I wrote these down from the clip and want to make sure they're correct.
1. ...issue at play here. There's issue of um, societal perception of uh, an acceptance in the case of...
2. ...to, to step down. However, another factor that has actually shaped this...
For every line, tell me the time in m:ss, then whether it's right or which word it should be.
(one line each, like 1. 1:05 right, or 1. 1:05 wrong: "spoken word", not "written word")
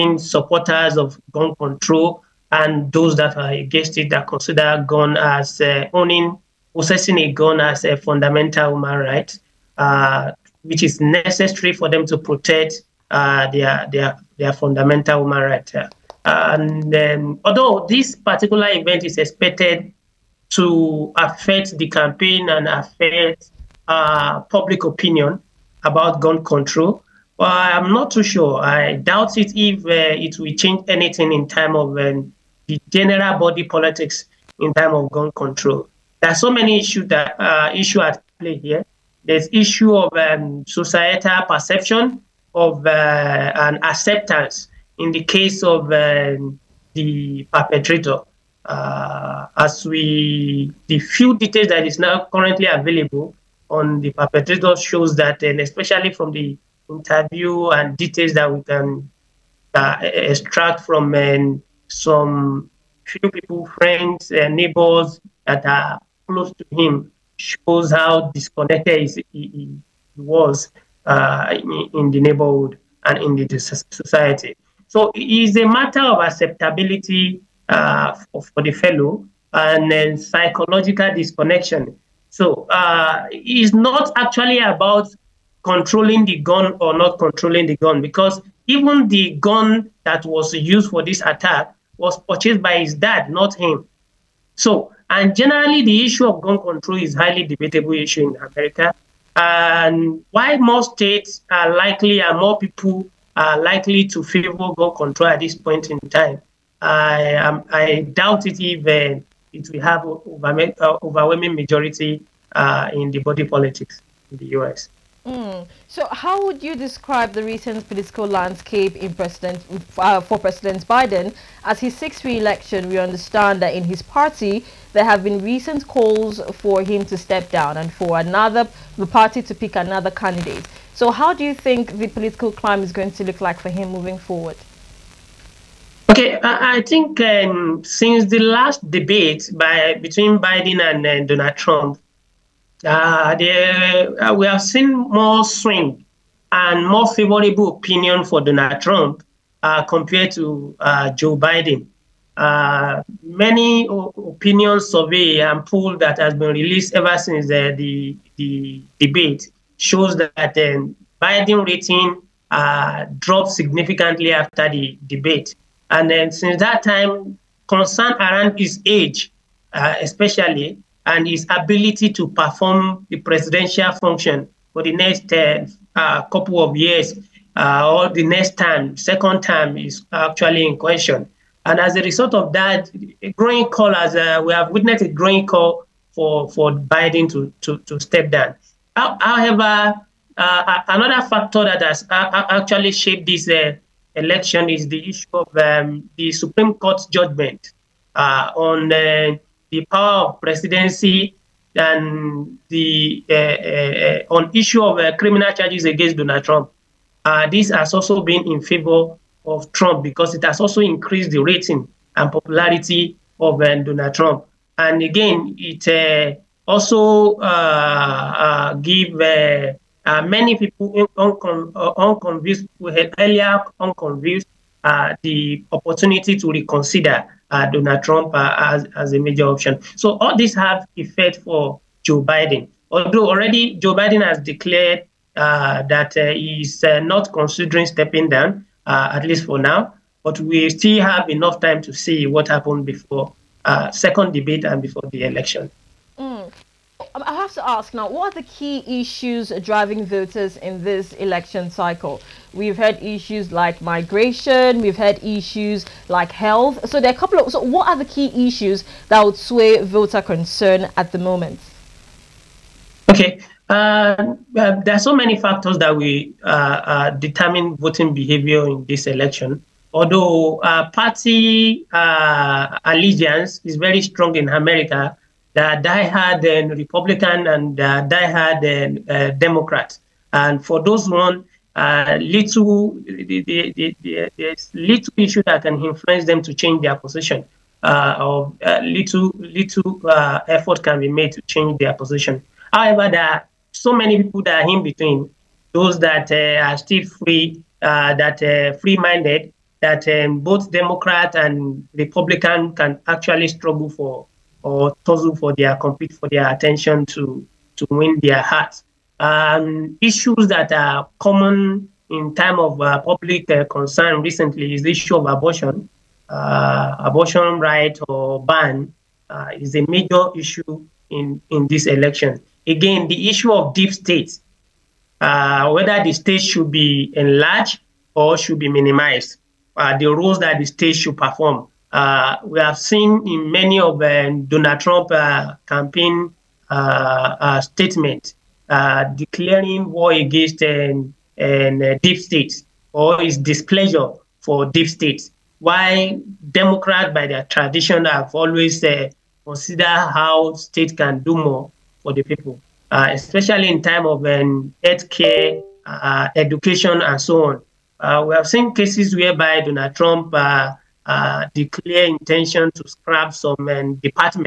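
1. 0:37 right
2. 3:07 right.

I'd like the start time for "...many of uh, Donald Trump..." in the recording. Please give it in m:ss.
5:33.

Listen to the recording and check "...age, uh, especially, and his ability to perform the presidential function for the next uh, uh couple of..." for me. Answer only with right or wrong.
right.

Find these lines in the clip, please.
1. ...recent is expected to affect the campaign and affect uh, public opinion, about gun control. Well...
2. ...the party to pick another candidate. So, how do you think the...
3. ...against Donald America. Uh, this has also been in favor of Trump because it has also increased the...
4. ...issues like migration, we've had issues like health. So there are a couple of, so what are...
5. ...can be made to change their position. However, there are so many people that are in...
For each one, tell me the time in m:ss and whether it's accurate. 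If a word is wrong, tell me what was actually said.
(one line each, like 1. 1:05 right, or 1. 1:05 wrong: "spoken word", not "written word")
1. 0:18 wrong: "event", not "recent"
2. 2:08 right
3. 3:25 wrong: "Trump", not "America"
4. 4:13 right
5. 4:50 right.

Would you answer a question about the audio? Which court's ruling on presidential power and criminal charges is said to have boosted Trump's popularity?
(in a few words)
The Supreme Court.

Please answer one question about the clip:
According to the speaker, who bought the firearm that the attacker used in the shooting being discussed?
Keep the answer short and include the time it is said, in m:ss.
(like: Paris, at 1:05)
His dad, at 1:32.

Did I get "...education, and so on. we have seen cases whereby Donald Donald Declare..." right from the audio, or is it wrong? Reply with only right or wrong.
wrong.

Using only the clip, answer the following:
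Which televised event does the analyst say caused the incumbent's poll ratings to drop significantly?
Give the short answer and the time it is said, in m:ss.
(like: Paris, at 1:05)
The last debate, at 2:18.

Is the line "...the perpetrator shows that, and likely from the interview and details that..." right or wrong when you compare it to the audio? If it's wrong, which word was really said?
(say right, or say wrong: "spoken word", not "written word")
wrong: "especially", not "likely".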